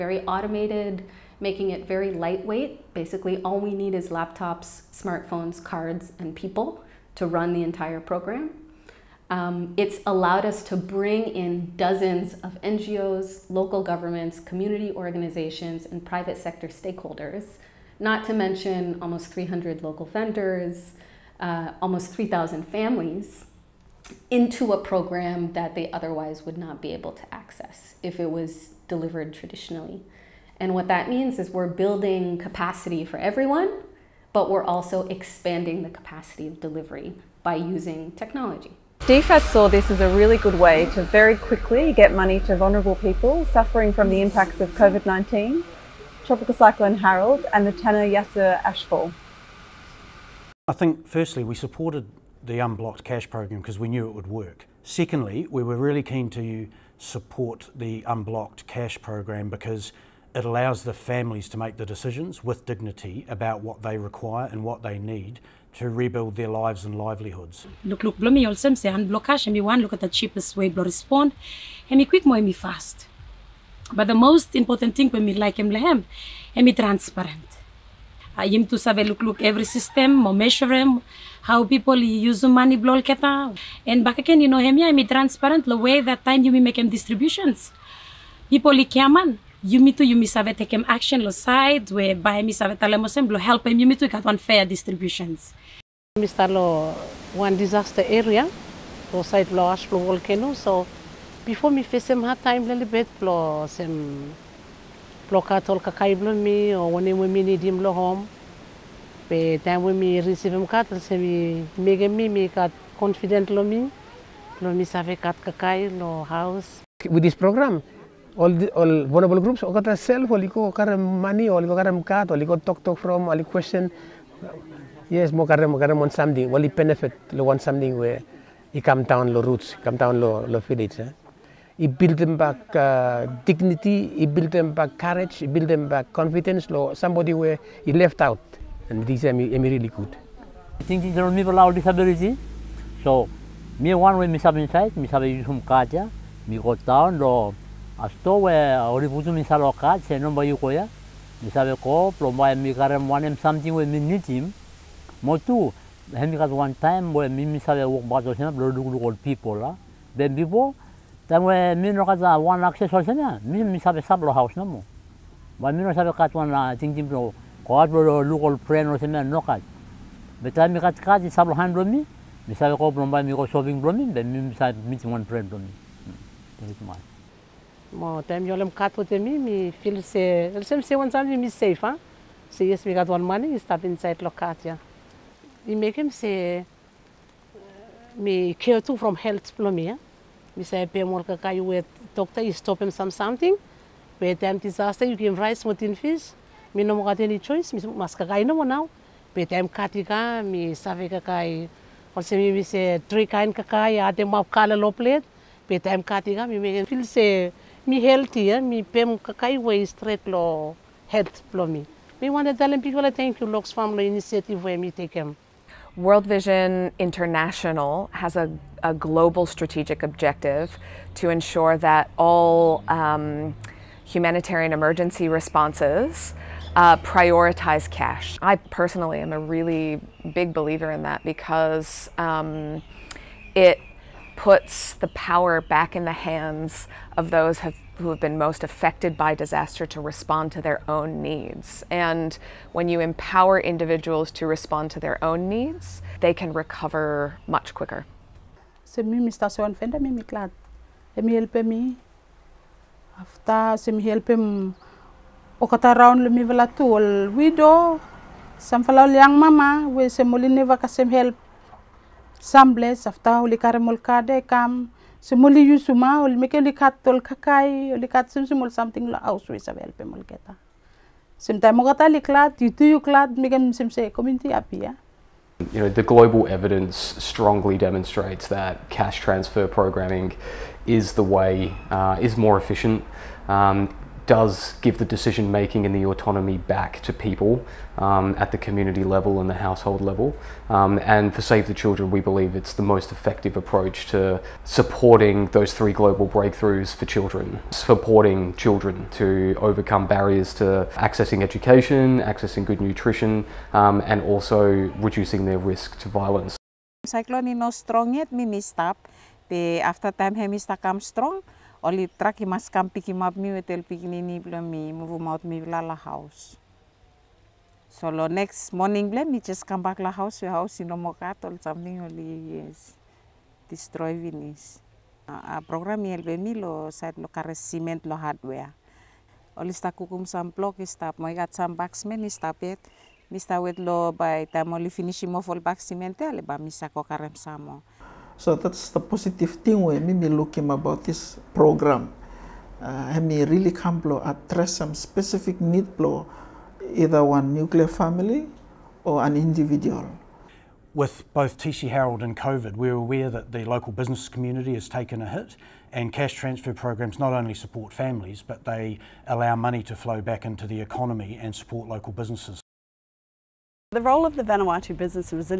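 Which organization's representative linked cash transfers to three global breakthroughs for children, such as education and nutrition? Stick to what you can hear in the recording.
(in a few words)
Save the Children.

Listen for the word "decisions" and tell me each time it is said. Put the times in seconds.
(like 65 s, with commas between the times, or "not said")
61 s, 285 s.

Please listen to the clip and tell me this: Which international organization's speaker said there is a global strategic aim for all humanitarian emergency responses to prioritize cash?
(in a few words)
World Vision International.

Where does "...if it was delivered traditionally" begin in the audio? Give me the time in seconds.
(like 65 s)
28 s.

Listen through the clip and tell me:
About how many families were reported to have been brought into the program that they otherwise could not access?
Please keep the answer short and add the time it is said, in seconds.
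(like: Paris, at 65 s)
3,000, at 21 s.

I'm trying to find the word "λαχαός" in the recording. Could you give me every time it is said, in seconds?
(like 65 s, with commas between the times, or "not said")
315 s, 319 s.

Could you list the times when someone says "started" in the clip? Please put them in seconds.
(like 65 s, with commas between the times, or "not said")
not said.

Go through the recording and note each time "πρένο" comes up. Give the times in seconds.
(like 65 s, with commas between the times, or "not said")
168 s.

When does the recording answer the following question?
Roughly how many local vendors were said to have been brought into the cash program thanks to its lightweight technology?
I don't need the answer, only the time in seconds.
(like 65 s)
19 s.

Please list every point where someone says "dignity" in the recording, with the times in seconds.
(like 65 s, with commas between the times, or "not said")
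62 s, 133 s.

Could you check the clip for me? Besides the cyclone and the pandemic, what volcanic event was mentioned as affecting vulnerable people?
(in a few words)
Tanna Yasur ashfall.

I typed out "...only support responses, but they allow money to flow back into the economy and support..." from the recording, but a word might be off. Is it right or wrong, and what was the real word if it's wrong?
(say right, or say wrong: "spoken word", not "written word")
wrong: "families", not "responses".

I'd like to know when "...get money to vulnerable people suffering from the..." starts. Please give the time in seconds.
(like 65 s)
41 s.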